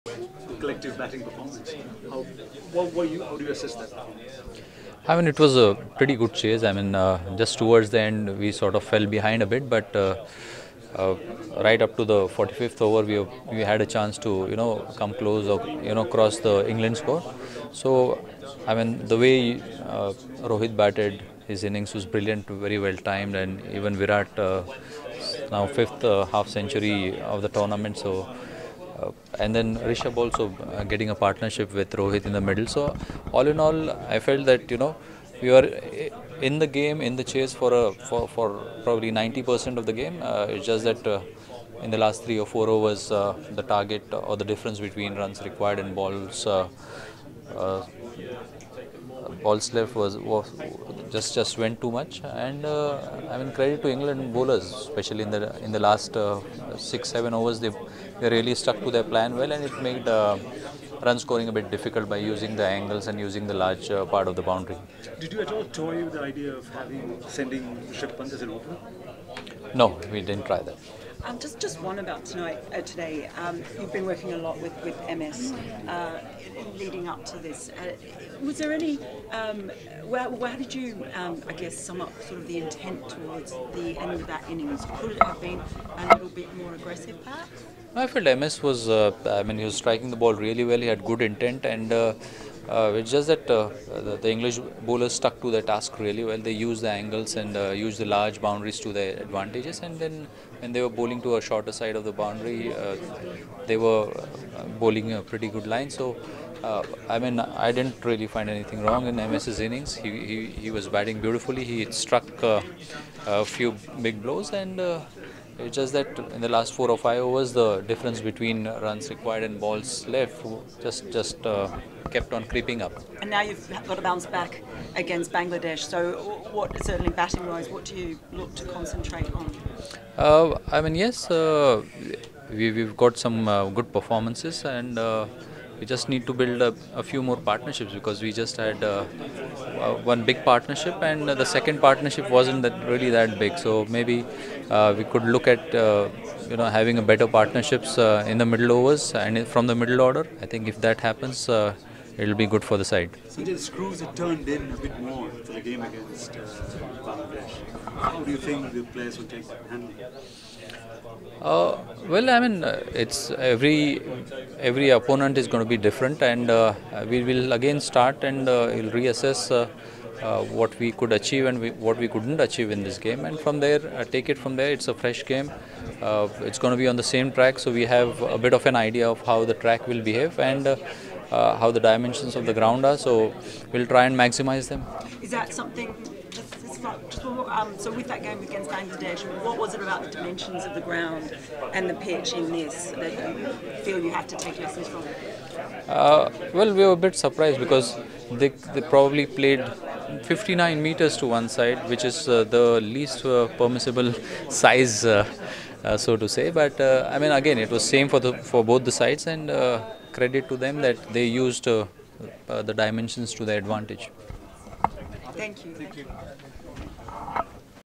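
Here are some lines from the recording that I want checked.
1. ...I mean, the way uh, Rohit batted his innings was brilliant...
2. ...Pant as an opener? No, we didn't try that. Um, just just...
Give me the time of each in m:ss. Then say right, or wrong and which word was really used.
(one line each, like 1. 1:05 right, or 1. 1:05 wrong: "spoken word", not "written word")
1. 0:18 right
2. 1:08 right.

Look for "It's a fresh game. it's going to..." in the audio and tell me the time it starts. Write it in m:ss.
2:54.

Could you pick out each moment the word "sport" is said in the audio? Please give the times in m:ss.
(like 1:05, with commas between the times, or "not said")
not said.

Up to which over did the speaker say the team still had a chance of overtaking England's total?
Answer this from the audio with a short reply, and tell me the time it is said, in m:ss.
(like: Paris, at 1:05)
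45th, at 0:12.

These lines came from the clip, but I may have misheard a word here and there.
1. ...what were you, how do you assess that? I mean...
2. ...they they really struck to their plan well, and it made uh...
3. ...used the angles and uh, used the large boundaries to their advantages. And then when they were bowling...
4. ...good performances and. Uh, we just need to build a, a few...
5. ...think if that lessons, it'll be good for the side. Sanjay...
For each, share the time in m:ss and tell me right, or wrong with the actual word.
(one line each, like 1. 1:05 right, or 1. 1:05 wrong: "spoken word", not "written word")
1. 0:02 right
2. 0:57 wrong: "stuck", not "struck"
3. 1:36 right
4. 2:13 right
5. 2:30 wrong: "happens", not "lessons".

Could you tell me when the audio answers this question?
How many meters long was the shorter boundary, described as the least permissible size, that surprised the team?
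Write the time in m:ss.
3:20.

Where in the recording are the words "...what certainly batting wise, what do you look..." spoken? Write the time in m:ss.
2:06.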